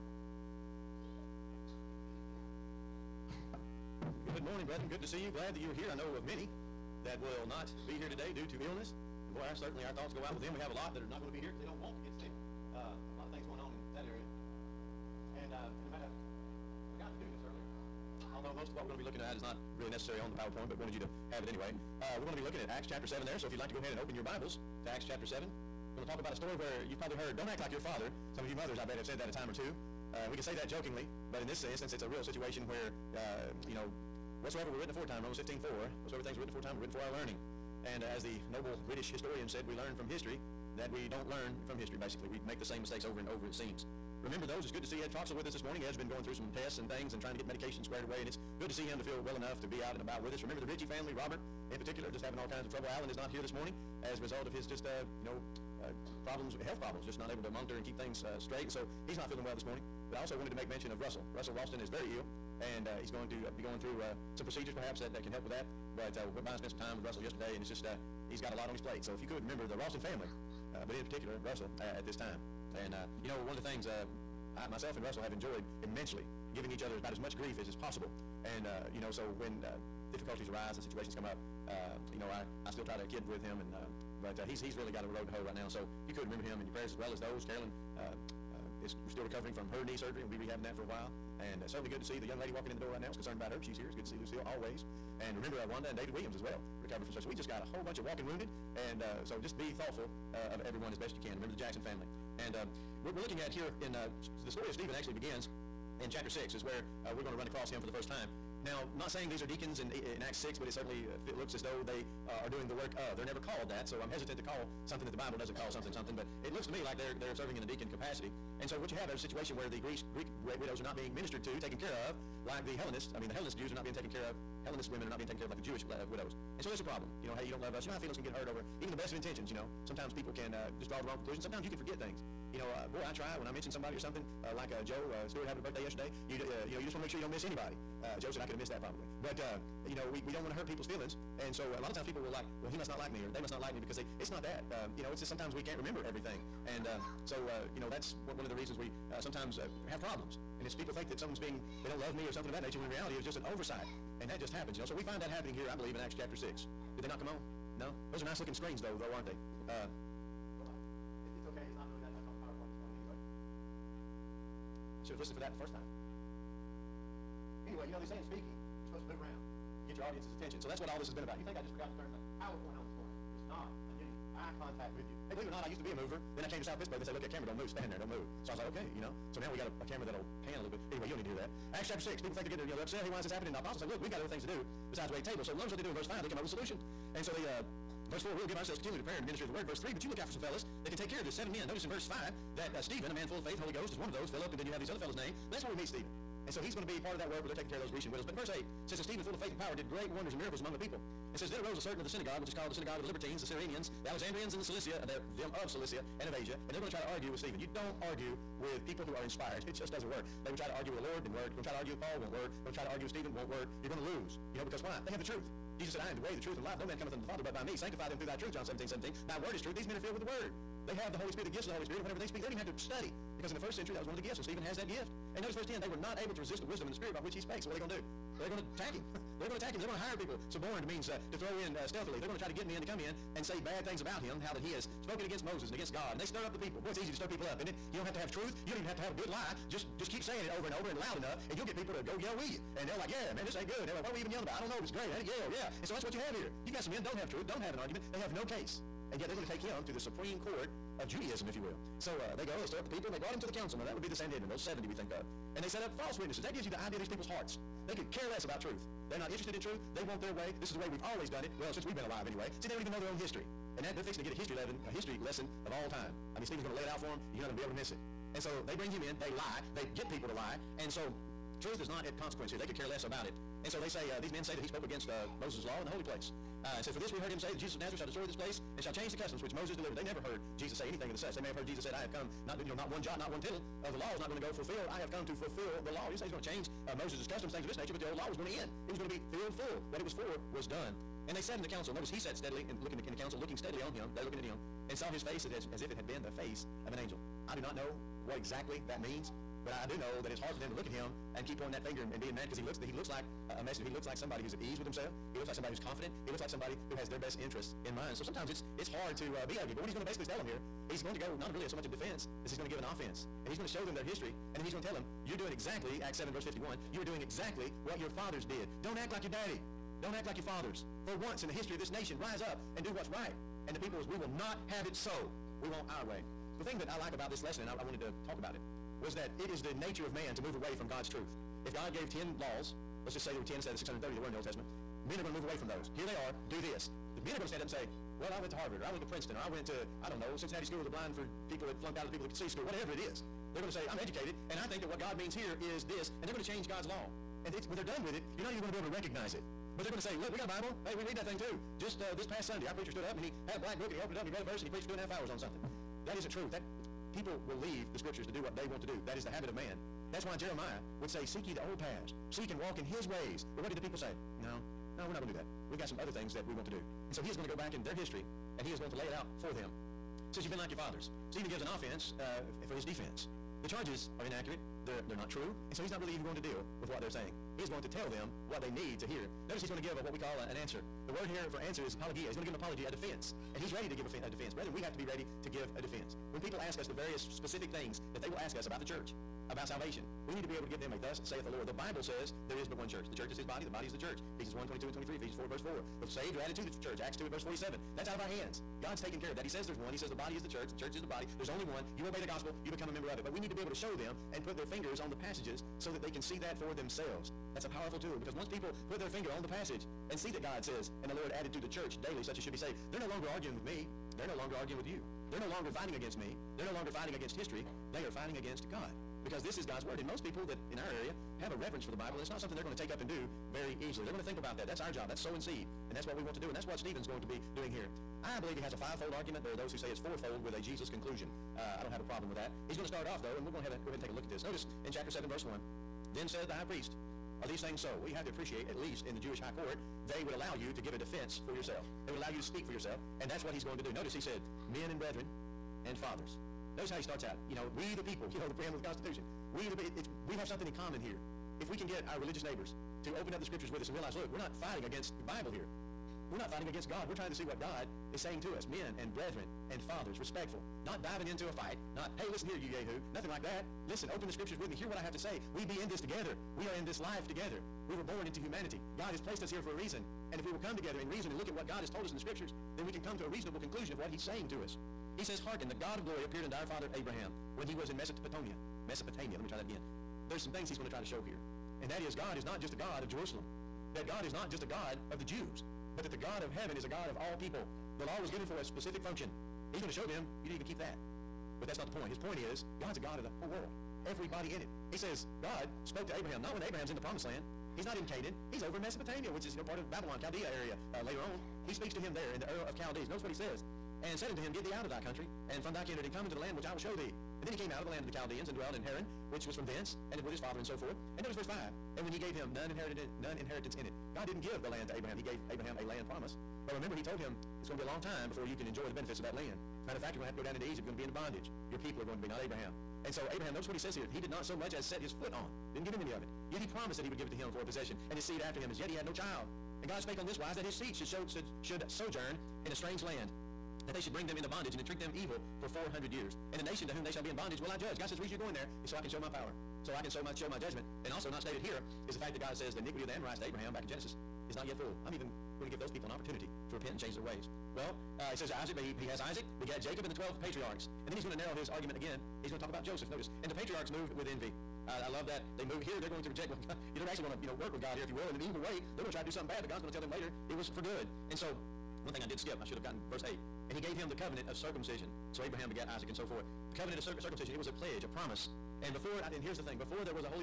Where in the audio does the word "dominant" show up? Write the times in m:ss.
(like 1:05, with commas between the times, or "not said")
not said.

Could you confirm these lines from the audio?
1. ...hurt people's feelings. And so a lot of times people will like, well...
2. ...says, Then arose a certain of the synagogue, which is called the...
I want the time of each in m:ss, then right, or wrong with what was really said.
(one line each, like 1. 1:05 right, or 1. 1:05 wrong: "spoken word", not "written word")
1. 2:20 right
2. 3:21 right.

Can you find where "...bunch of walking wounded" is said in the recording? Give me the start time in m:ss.
1:37.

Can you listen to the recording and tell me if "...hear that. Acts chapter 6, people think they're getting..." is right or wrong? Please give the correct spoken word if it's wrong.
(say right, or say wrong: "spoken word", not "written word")
right.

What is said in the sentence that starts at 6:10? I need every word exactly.
He says, You've been like your fathers.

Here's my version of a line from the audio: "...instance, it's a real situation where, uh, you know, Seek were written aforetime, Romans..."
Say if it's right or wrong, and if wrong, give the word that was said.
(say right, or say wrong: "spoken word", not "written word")
wrong: "Whatsoever", not "Seek".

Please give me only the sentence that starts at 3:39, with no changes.
These men are filled with the word.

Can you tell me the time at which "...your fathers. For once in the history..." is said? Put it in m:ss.
5:20.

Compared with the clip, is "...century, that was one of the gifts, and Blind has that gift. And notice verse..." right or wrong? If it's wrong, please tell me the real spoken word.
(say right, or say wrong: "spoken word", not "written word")
wrong: "Stephen", not "Blind".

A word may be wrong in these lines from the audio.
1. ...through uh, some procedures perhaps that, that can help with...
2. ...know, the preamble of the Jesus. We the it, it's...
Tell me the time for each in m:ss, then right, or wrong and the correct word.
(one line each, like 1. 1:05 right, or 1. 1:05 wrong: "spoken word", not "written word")
1. 1:03 right
2. 7:28 wrong: "Constitution", not "Jesus".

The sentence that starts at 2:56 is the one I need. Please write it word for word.
Then I came to South Pittsburgh.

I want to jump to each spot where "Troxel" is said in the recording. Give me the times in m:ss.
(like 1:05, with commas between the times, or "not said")
0:45.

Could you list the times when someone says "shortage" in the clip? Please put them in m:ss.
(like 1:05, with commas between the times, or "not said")
not said.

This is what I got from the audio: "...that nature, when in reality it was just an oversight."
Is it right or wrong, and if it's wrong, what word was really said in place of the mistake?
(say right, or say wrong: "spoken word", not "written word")
right.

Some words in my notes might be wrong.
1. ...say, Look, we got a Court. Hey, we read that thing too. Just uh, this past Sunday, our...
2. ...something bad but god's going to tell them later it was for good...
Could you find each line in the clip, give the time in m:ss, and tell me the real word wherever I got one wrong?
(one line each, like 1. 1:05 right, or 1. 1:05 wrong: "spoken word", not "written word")
1. 5:49 wrong: "Bible", not "Court"
2. 9:19 right.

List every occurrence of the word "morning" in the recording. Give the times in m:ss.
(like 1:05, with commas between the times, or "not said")
0:04, 0:45, 0:53, 0:59, 2:52.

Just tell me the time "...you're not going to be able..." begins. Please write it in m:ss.
4:27.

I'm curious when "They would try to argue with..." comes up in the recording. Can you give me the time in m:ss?
3:30.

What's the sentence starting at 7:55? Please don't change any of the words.
He says, Hearken, the God of glory appeared unto our father Abraham when he was in Mesopotamia.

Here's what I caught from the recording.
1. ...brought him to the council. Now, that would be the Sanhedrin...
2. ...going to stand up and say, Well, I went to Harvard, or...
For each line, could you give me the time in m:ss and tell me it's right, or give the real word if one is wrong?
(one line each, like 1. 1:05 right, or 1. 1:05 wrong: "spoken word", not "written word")
1. 4:13 right
2. 5:37 right.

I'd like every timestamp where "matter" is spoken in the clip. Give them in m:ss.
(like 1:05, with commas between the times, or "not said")
0:15, 8:39.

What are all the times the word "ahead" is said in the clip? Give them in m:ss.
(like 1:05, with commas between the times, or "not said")
0:23, 7:13.